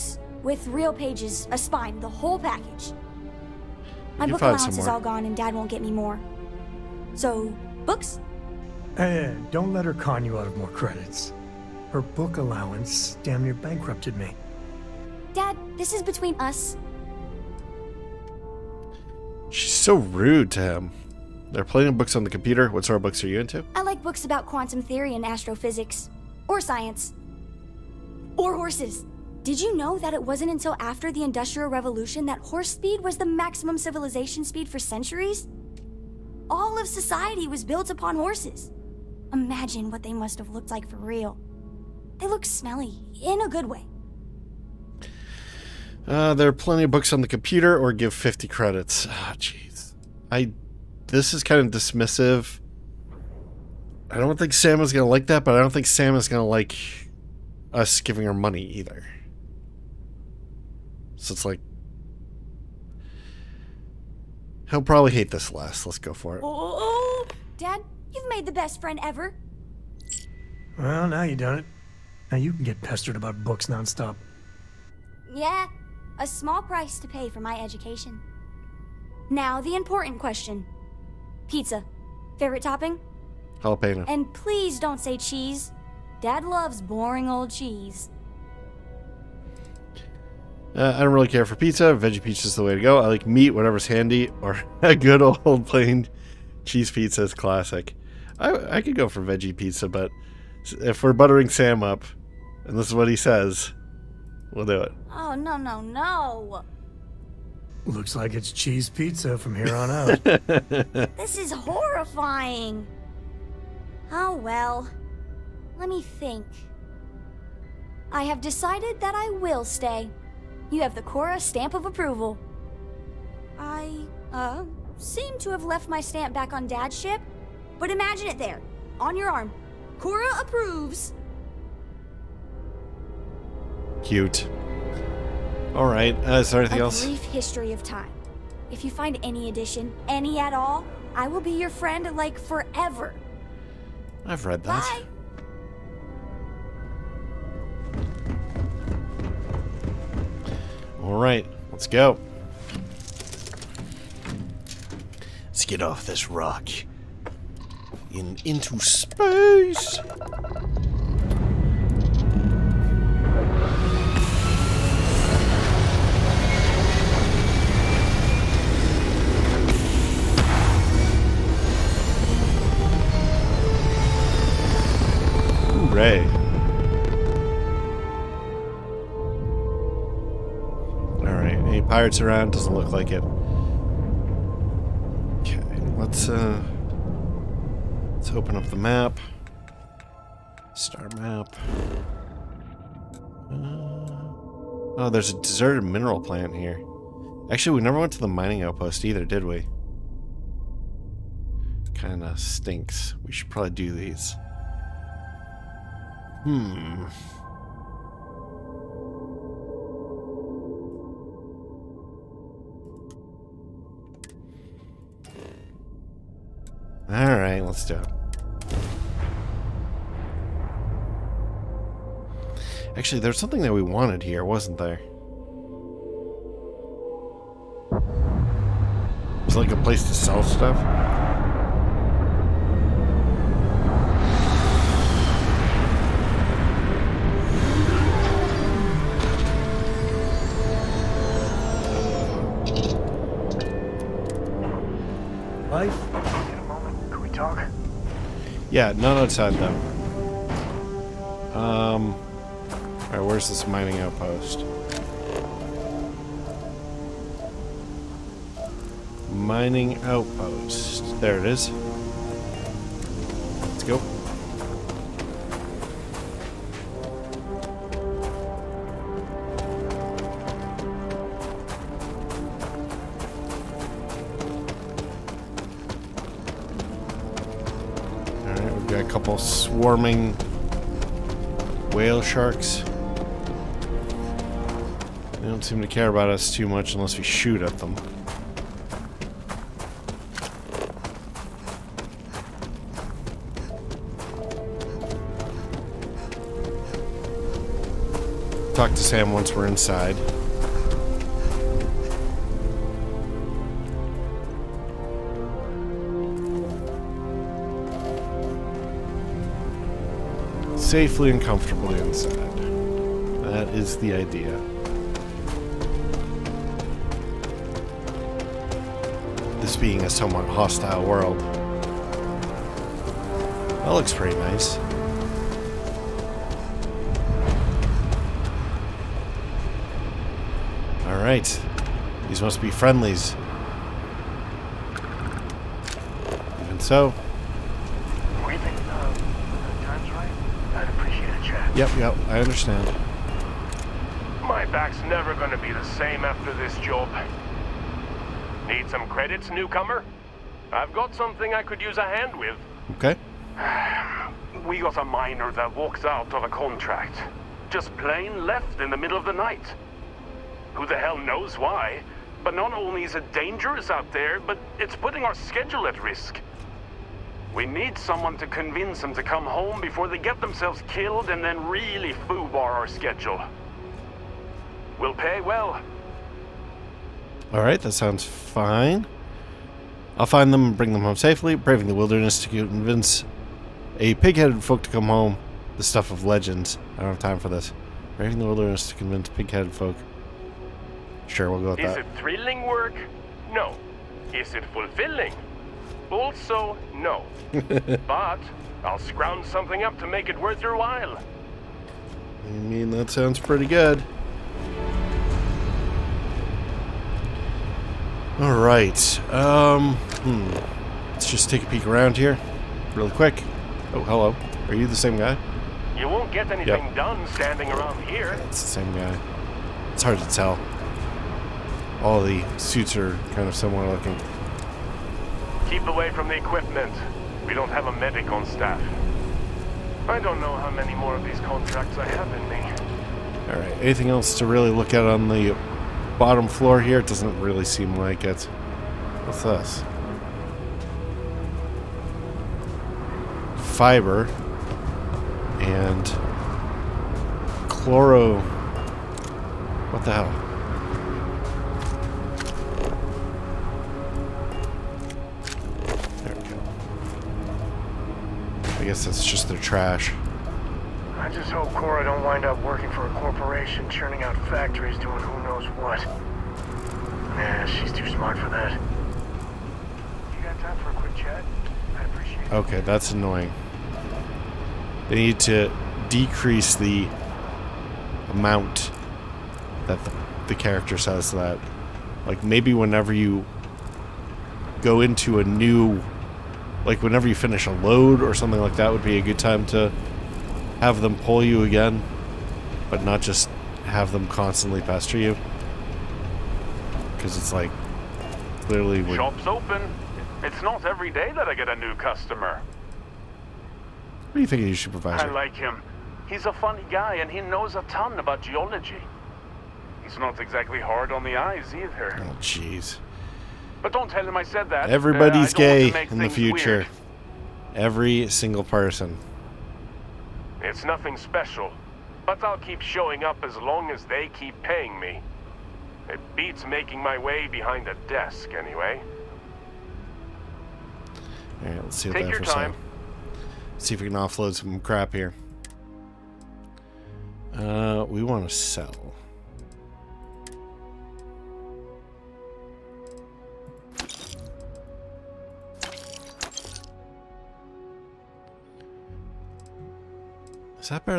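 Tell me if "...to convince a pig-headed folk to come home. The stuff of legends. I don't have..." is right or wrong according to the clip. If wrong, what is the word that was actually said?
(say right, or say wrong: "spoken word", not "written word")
right.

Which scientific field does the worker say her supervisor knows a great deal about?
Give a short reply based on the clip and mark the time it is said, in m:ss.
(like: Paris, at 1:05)
Geology, at 8:28.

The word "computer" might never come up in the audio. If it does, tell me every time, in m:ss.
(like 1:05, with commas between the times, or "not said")
0:22, 0:47.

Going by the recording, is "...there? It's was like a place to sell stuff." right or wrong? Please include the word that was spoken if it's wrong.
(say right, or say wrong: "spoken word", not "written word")
right.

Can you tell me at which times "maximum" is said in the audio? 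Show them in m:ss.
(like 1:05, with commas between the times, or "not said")
0:33.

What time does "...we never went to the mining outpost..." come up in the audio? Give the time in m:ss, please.
3:17.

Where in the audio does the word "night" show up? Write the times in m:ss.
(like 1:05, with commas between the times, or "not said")
5:59.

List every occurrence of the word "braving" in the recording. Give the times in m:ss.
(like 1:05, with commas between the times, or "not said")
6:21, 6:28.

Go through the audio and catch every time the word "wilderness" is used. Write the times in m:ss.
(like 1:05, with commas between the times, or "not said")
6:21, 6:28.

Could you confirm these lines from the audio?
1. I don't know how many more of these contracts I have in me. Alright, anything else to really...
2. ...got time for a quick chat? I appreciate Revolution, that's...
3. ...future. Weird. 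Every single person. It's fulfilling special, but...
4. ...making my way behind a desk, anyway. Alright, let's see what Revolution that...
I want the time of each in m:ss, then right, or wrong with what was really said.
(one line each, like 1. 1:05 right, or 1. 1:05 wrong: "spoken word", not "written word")
1. 7:10 right
2. 7:50 wrong: "Okay", not "Revolution"
3. 8:36 wrong: "nothing", not "fulfilling"
4. 8:46 wrong: "Take", not "Revolution".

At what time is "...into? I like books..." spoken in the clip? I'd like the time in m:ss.
0:23.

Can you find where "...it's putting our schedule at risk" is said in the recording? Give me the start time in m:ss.
6:04.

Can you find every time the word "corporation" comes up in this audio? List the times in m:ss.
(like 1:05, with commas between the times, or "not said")
7:43.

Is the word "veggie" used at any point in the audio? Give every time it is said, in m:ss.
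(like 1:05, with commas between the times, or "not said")
1:31, 1:39.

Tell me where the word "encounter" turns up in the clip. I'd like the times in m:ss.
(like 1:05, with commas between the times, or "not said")
not said.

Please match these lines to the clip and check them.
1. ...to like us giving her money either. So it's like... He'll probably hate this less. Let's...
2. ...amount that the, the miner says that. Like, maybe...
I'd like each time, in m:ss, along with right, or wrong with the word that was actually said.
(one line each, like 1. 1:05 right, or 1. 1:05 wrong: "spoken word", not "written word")
1. 0:56 right
2. 7:58 wrong: "character", not "miner".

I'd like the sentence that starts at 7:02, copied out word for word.
All the suits are kind of similar looking.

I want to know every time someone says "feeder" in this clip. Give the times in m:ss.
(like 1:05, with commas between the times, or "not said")
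not said.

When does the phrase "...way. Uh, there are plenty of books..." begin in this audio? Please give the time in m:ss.
0:43.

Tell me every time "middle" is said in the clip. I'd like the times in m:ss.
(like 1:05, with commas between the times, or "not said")
5:58.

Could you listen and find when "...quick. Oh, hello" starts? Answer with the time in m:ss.
6:53.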